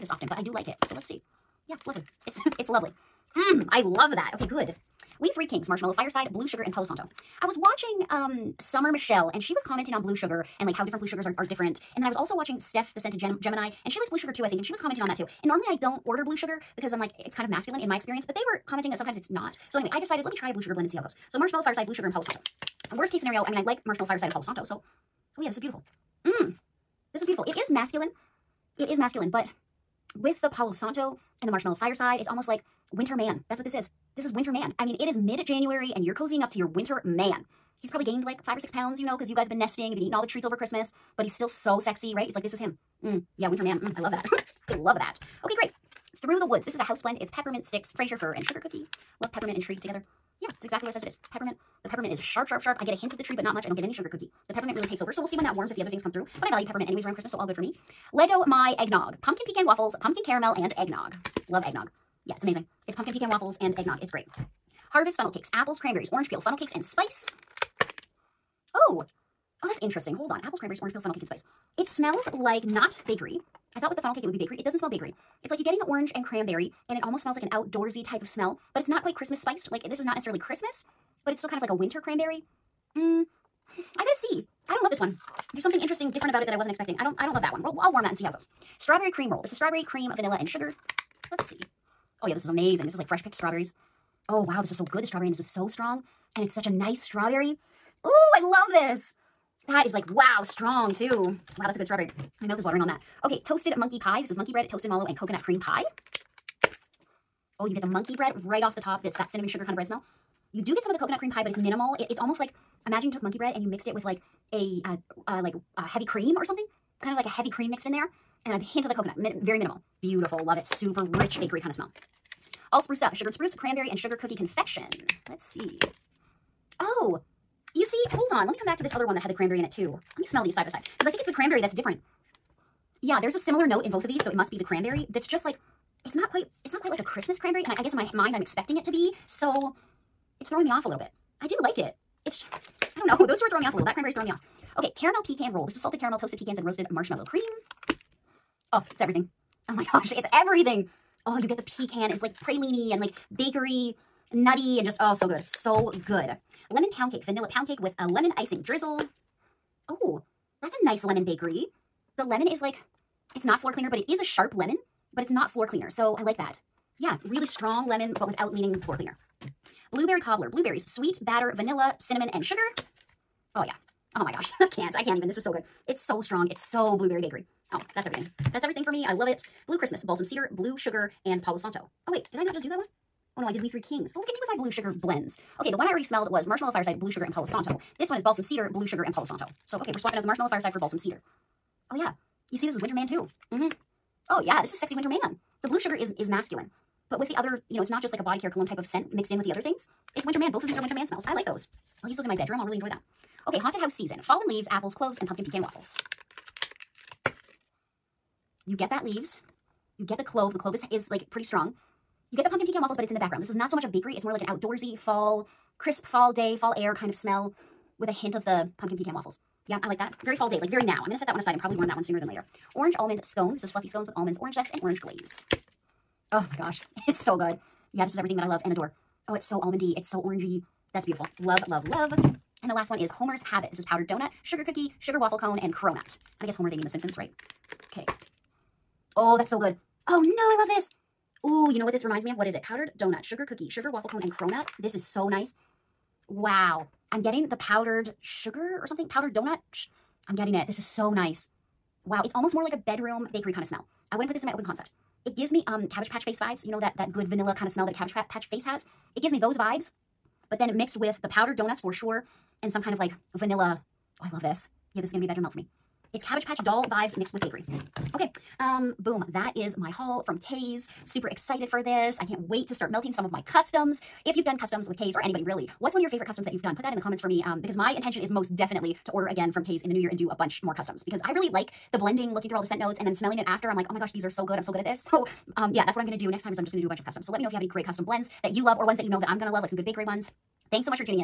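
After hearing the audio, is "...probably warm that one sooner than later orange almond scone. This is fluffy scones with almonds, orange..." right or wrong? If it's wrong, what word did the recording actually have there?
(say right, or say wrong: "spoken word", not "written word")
right.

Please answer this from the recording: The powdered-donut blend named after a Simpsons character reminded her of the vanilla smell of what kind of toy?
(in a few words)
Cabbage Patch doll.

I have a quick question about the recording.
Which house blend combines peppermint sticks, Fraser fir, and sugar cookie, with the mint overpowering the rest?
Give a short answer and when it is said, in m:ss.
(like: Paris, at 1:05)
Through the Woods, at 0:46.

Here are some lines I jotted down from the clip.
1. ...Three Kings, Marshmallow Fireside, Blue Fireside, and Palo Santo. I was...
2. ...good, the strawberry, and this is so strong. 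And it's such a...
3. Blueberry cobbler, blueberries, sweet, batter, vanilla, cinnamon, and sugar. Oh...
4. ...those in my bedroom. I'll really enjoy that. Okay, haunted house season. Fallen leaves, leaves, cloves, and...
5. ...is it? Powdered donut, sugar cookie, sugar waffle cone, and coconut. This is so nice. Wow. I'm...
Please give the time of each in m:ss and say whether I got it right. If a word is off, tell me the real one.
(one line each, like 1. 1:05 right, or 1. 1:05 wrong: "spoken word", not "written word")
1. 0:05 wrong: "Sugar", not "Fireside"
2. 1:34 right
3. 2:49 right
4. 3:22 wrong: "apples", not "leaves"
5. 4:02 wrong: "cronut", not "coconut".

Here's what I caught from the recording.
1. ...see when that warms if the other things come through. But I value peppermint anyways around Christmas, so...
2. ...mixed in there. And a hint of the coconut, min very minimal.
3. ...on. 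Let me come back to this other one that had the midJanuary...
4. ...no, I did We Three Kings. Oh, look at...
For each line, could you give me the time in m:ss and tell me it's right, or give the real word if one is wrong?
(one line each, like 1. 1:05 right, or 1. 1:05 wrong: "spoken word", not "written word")
1. 0:55 right
2. 1:57 right
3. 2:08 wrong: "cranberry", not "midJanuary"
4. 3:03 right.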